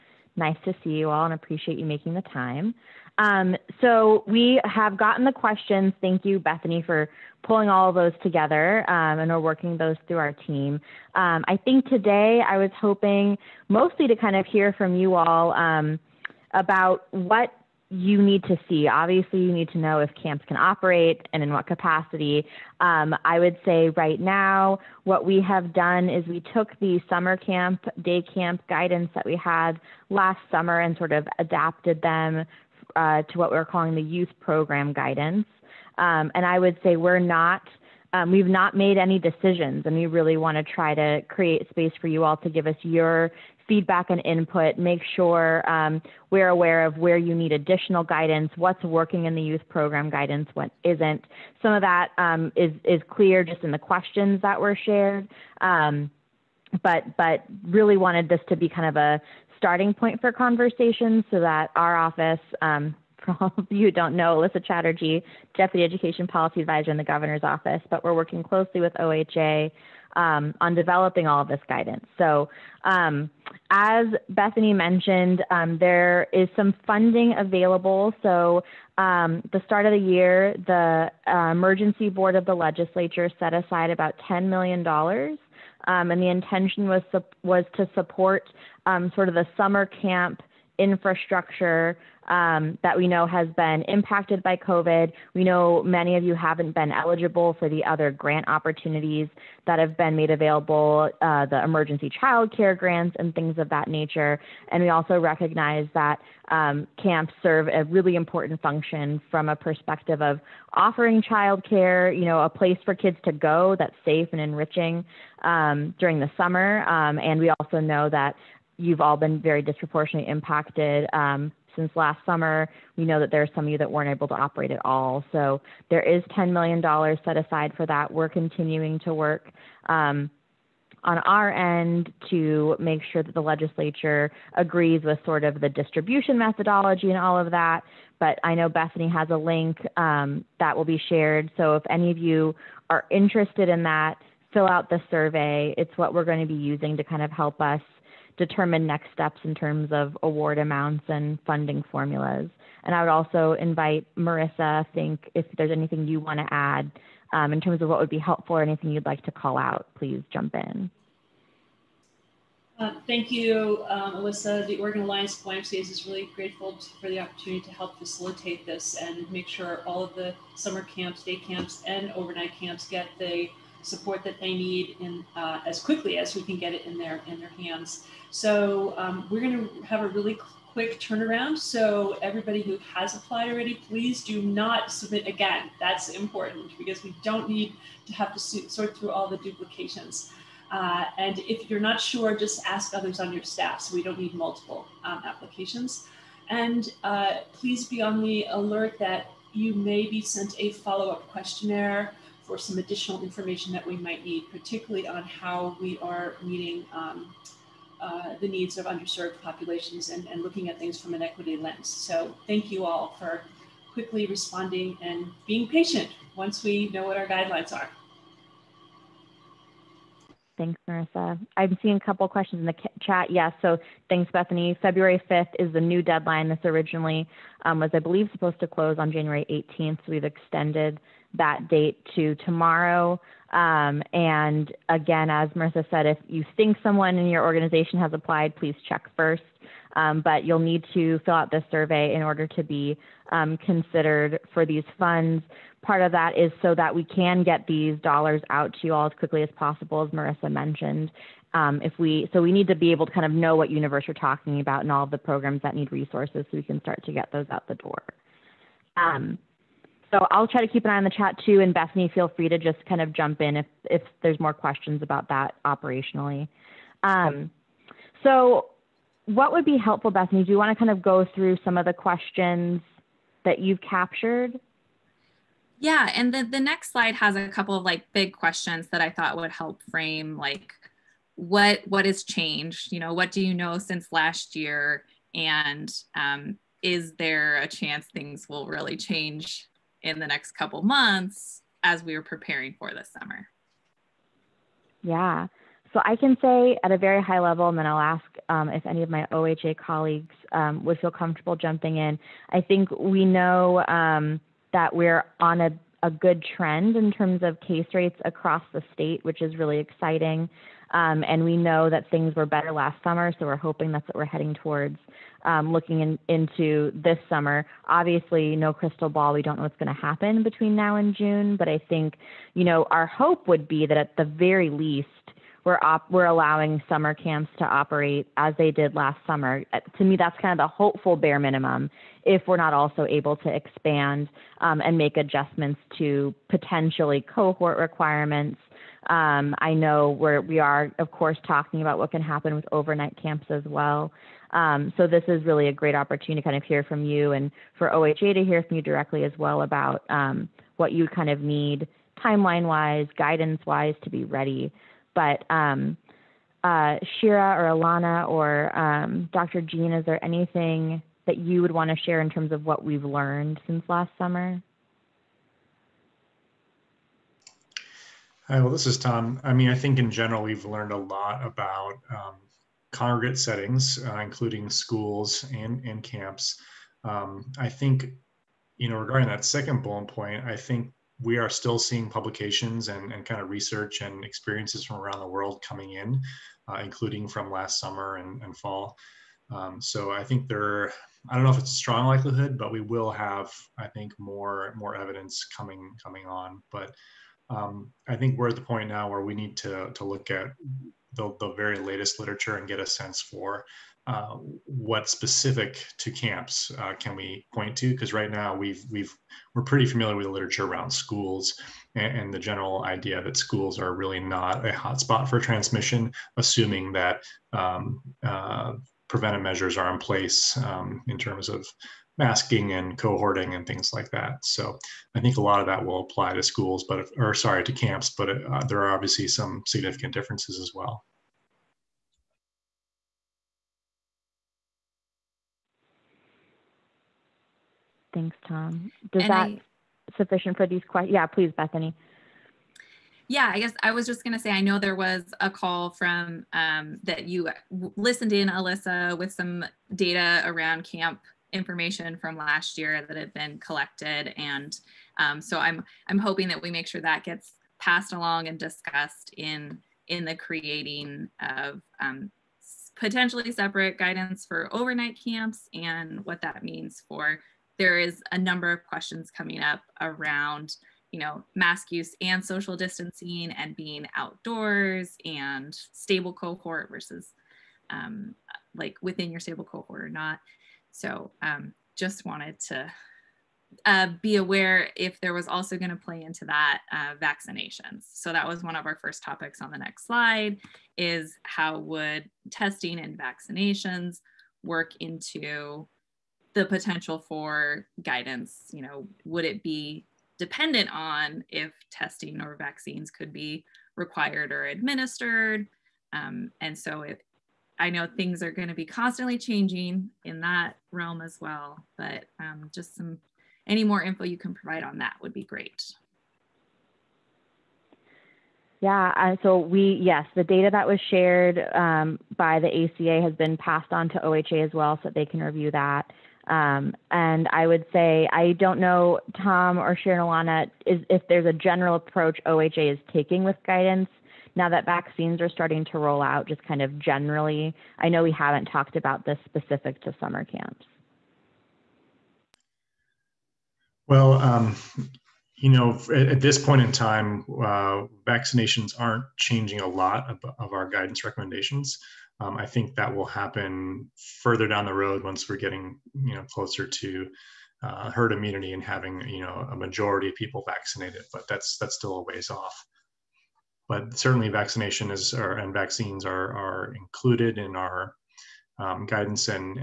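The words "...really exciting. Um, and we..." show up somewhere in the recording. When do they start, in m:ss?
5:09.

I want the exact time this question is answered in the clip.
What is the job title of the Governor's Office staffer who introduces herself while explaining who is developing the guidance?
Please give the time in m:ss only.
1:05.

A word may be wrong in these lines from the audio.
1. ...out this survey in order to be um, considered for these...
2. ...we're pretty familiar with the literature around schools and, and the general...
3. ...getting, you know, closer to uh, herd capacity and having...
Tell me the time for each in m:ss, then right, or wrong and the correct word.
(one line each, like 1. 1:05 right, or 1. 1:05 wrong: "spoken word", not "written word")
1. 4:01 right
2. 6:49 right
3. 9:15 wrong: "immunity", not "capacity".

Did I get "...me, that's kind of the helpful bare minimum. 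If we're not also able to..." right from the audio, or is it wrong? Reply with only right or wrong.
wrong.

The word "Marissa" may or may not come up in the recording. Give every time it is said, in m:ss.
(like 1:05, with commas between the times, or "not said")
2:34, 3:40, 3:55, 4:10.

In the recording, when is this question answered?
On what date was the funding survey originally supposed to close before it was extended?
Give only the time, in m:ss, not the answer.
3:49.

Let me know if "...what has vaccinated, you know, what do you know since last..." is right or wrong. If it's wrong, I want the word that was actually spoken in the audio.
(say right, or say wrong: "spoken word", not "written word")
wrong: "changed", not "vaccinated".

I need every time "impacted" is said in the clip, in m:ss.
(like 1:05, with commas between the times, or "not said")
1:33, 2:00.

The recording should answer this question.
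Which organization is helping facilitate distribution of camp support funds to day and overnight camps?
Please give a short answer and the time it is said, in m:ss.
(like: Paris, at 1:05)
Oregon Alliance of YMCAs, at 2:44.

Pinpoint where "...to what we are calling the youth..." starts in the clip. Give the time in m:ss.
0:33.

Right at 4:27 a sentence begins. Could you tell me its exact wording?
Um, so what would be helpful, Bethany?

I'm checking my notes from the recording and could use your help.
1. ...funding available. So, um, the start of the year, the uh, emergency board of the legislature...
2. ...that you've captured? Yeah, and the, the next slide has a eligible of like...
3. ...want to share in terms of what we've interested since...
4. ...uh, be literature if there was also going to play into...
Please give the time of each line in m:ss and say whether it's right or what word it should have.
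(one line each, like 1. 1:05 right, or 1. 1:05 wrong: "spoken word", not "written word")
1. 1:16 right
2. 4:33 wrong: "couple", not "eligible"
3. 6:01 wrong: "learned", not "interested"
4. 8:03 wrong: "aware", not "literature".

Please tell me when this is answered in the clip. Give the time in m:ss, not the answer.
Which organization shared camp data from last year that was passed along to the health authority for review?
8:42.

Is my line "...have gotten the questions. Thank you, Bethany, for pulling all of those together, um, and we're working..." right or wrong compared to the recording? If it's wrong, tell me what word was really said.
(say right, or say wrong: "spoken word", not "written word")
right.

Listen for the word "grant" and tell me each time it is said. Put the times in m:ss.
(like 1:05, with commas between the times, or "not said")
1:38, 1:42.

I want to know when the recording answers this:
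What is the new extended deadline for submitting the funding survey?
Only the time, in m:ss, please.
3:44.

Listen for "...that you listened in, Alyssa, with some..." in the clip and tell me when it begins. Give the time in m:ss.
7:27.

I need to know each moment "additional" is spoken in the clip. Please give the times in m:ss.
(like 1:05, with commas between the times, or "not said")
0:47, 3:22.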